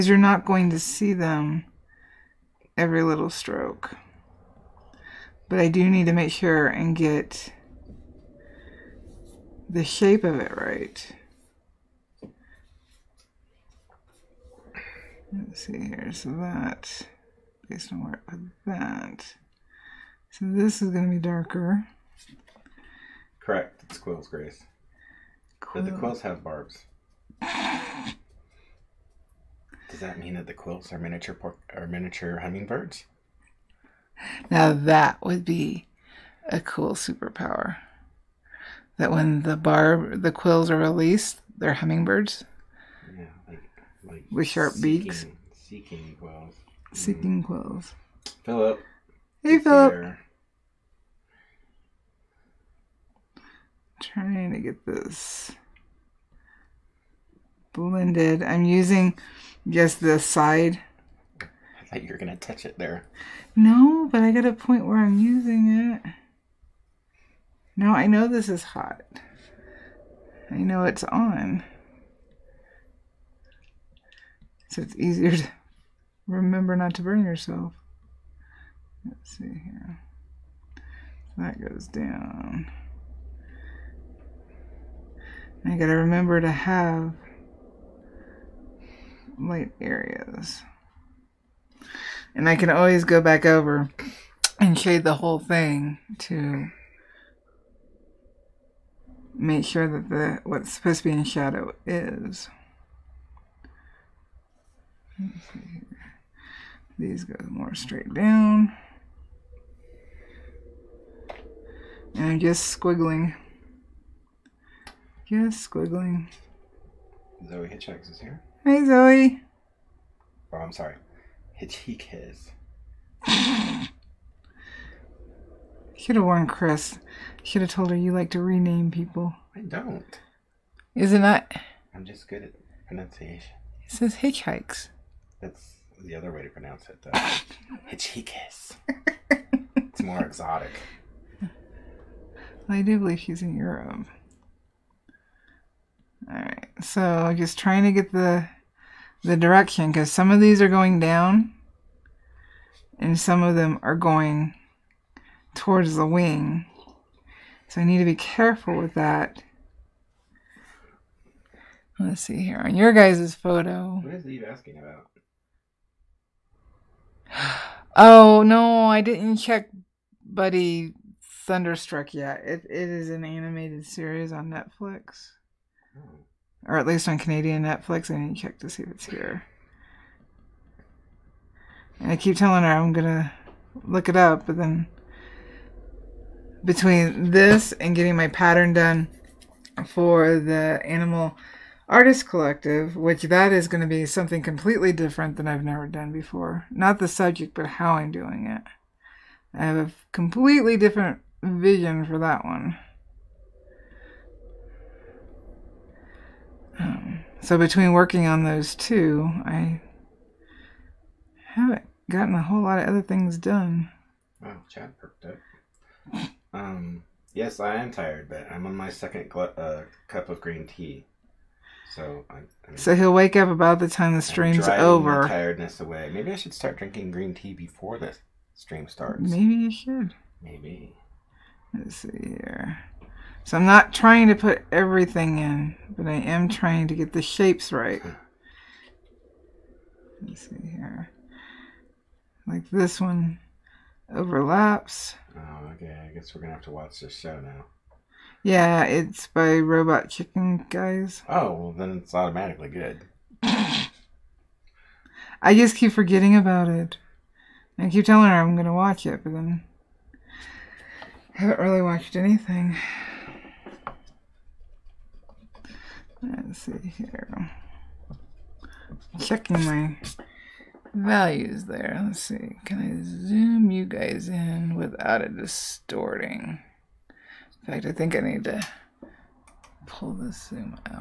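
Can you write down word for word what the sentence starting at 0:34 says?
Now that would be a cool superpower that when the barb, the quills are released, they're hummingbirds.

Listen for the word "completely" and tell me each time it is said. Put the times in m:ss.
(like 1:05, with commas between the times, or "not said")
3:14, 3:20.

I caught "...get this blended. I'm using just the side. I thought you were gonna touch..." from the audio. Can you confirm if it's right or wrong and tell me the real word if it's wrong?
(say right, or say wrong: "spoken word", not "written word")
right.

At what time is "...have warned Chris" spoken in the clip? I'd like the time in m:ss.
2:06.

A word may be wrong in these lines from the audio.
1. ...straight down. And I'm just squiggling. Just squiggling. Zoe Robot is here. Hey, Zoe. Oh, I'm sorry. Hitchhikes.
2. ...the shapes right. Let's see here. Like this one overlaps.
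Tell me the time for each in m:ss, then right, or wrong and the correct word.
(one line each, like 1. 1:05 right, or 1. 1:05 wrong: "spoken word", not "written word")
1. 1:47 wrong: "Hitchhikes", not "Robot"
2. 3:57 right.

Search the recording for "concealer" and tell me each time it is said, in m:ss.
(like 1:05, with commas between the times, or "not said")
not said.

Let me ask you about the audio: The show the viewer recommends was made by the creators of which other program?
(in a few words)
Robot Chicken.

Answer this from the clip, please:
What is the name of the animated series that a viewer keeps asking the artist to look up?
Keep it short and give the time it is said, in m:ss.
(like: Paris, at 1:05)
Buddy Thunderstruck, at 2:50.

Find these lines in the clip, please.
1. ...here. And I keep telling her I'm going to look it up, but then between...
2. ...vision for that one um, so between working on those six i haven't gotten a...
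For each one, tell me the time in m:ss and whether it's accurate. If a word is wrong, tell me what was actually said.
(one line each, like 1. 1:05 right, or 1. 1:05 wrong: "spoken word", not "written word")
1. 2:59 right
2. 3:21 wrong: "two", not "six".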